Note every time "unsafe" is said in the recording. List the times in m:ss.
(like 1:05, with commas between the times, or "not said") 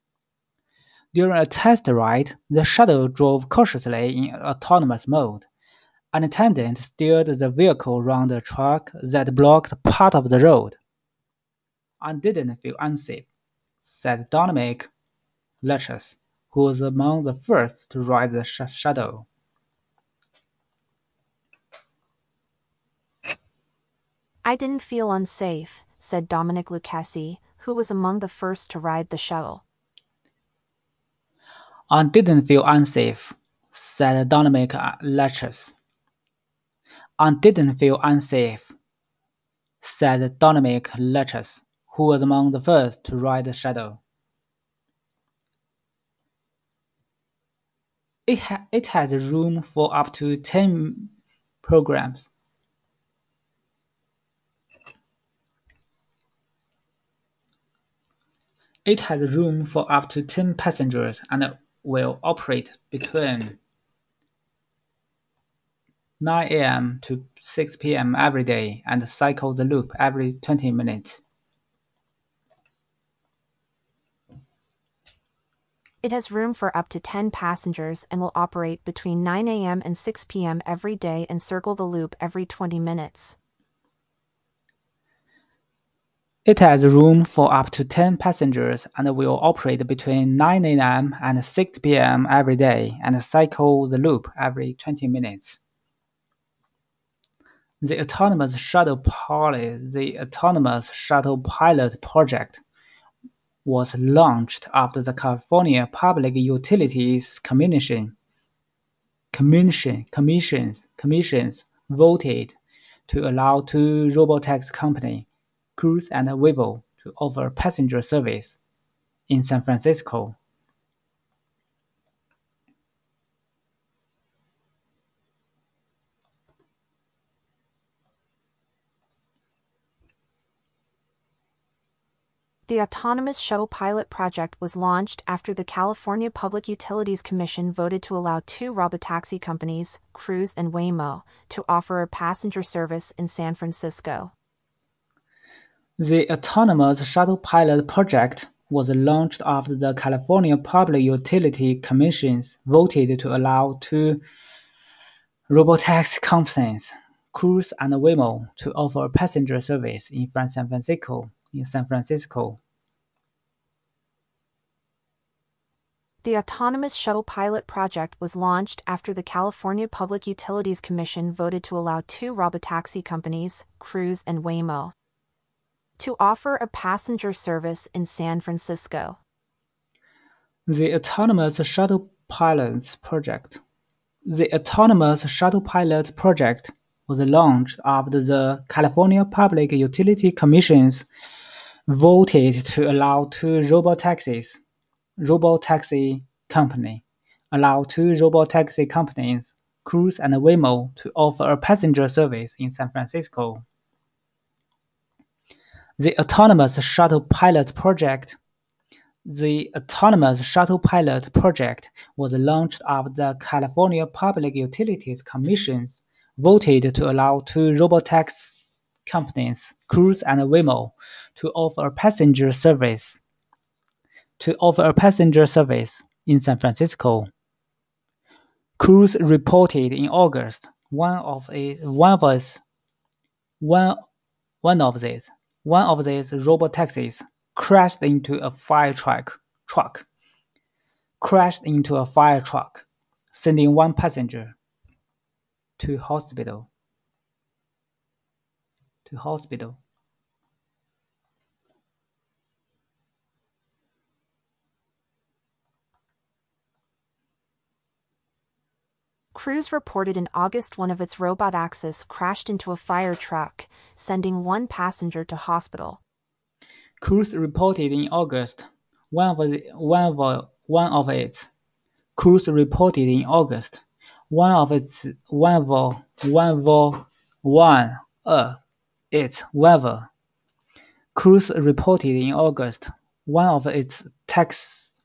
0:12, 0:25, 0:32, 0:38.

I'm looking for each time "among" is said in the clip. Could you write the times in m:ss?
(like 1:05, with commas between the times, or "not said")
0:16, 0:27, 0:42.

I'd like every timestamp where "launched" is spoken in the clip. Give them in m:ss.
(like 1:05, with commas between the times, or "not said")
1:43, 2:14, 2:28, 2:48, 3:07, 3:32.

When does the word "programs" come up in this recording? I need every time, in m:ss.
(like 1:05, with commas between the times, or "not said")
0:51.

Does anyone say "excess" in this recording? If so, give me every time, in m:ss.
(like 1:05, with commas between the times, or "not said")
not said.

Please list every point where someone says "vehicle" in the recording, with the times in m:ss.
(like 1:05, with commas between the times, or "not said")
0:07.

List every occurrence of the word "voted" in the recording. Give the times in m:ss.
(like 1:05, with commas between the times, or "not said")
1:51, 2:17, 2:32, 2:51, 3:11, 3:36.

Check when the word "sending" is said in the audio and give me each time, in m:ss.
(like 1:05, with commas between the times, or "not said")
4:03, 4:23.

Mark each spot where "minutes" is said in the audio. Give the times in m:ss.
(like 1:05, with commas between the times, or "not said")
1:10, 1:22, 1:35.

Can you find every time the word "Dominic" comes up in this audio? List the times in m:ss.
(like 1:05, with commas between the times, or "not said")
0:14, 0:26, 0:34, 0:40.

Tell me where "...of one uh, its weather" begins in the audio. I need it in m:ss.
4:36.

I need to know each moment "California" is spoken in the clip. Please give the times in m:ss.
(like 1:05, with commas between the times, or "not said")
1:45, 2:15, 2:29, 2:49, 3:08, 3:33.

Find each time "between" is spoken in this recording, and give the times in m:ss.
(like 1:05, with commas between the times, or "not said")
1:02, 1:18, 1:29.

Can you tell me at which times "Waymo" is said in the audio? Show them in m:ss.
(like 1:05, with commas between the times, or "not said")
2:20, 2:37, 2:54, 3:20, 3:40.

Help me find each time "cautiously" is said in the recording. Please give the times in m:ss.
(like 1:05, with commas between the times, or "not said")
0:03.